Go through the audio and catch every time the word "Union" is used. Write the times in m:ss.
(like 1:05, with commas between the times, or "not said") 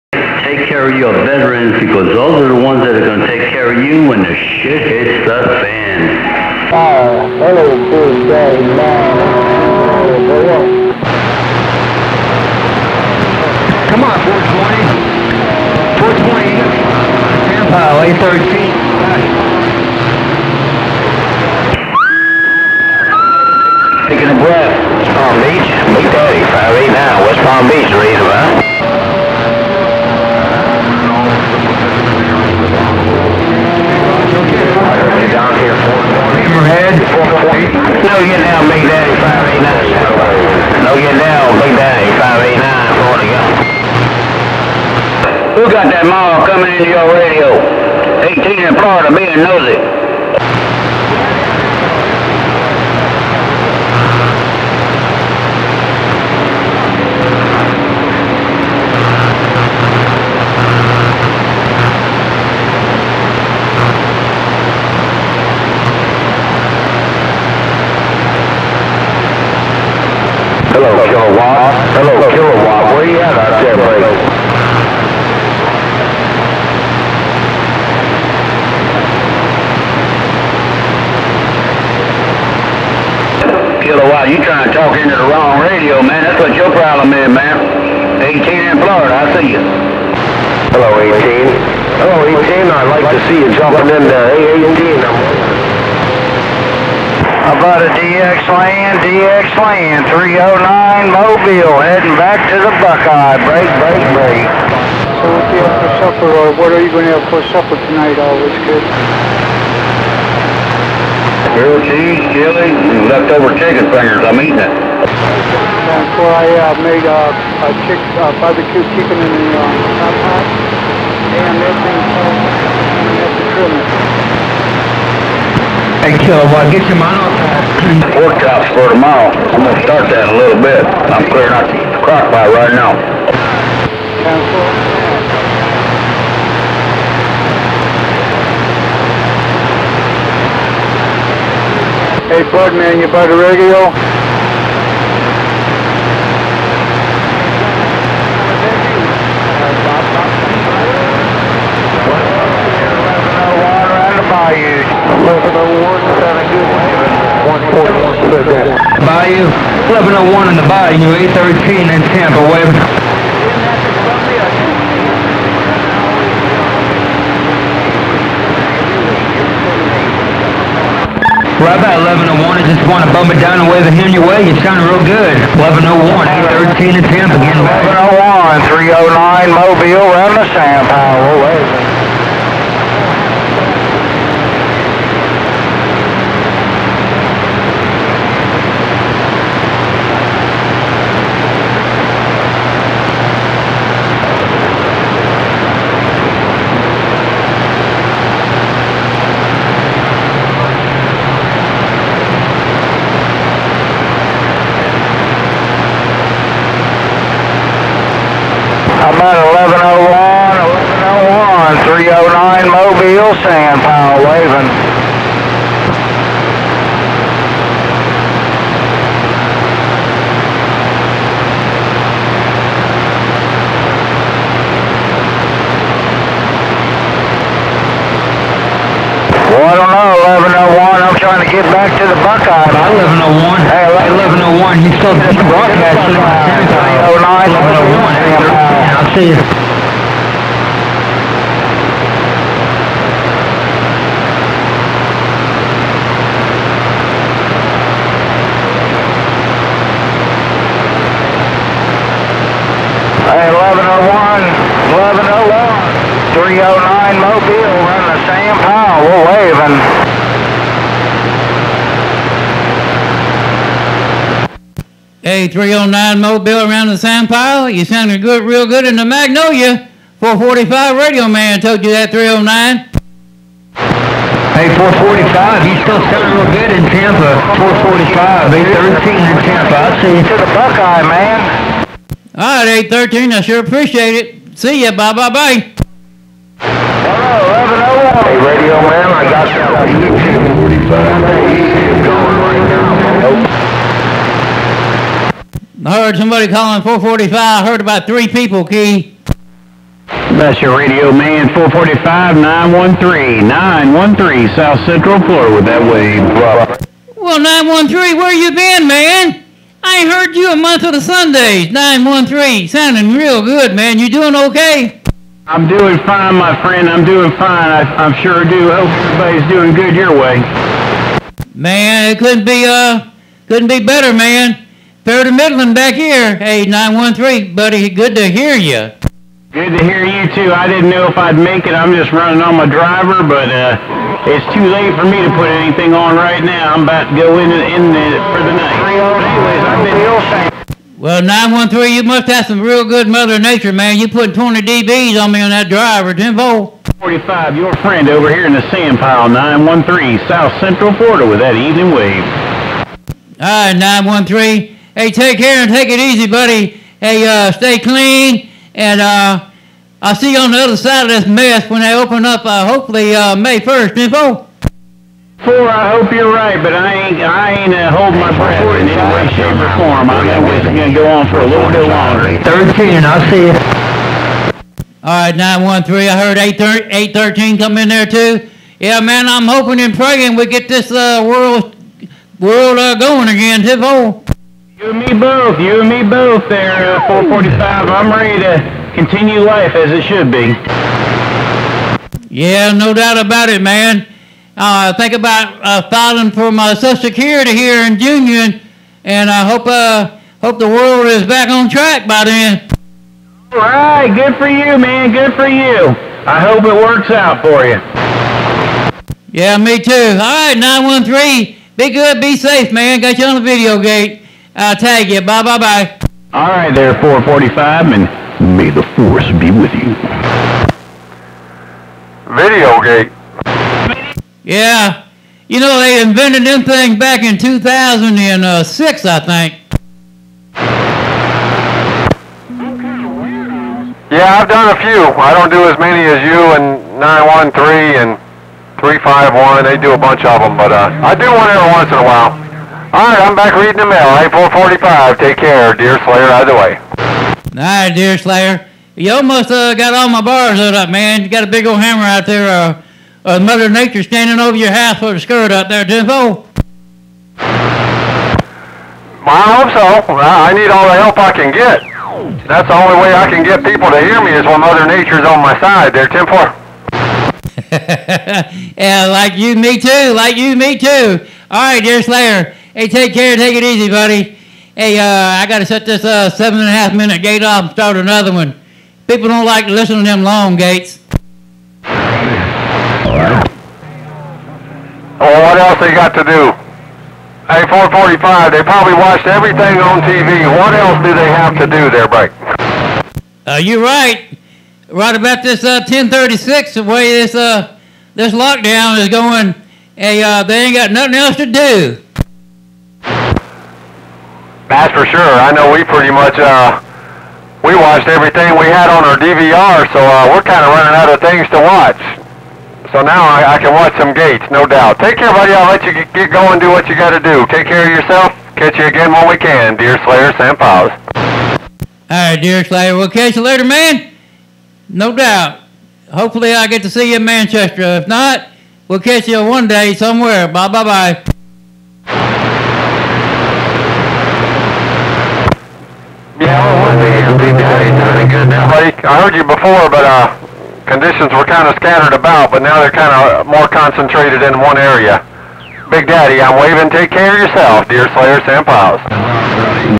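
6:37.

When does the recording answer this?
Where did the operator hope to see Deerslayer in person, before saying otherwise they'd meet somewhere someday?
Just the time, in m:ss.
8:47.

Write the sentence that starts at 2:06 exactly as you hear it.
Hey, Kilowatt, get your mind off Workout's for tomorrow.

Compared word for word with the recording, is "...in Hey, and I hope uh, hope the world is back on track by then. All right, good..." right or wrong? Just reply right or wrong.
wrong.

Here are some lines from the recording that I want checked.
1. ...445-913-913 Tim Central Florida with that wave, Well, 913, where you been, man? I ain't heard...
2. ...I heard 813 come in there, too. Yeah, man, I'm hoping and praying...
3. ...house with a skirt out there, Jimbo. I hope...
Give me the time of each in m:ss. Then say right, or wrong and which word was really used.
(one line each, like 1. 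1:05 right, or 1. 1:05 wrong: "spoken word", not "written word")
1. 5:01 wrong: "South", not "Tim"
2. 6:16 right
3. 7:34 right.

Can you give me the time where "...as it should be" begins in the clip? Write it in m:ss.
6:29.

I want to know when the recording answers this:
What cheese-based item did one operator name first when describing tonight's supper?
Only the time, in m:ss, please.
1:51.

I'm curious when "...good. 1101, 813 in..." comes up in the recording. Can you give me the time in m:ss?
2:55.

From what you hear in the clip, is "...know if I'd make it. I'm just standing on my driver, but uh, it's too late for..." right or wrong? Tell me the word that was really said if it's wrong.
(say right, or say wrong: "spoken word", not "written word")
wrong: "running", not "standing".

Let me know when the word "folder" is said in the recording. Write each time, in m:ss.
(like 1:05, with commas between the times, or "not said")
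not said.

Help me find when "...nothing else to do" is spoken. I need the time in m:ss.
8:20.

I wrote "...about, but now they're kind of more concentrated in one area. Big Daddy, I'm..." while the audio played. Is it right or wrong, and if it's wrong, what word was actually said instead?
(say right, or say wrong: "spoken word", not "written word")
right.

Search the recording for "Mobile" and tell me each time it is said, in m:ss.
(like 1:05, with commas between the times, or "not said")
1:41, 2:59, 3:32, 4:26.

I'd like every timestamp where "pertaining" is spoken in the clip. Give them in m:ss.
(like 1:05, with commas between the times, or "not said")
not said.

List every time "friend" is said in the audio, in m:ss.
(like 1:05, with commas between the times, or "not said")
5:16, 5:47.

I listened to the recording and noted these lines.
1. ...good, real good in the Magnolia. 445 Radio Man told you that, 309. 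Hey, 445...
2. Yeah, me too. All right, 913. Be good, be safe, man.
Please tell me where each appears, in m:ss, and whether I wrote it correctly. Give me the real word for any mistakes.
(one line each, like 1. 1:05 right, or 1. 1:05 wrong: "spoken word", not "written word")
1. 4:28 right
2. 6:49 right.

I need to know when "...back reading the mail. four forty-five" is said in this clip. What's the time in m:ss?
7:23.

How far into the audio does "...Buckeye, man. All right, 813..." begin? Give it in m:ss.
4:40.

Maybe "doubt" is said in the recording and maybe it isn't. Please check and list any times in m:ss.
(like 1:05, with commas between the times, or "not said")
6:32, 8:34, 8:45.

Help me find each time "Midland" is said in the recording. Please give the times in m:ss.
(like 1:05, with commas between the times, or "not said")
5:25.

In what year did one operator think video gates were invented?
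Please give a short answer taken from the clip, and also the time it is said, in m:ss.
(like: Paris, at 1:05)
2006, at 7:07.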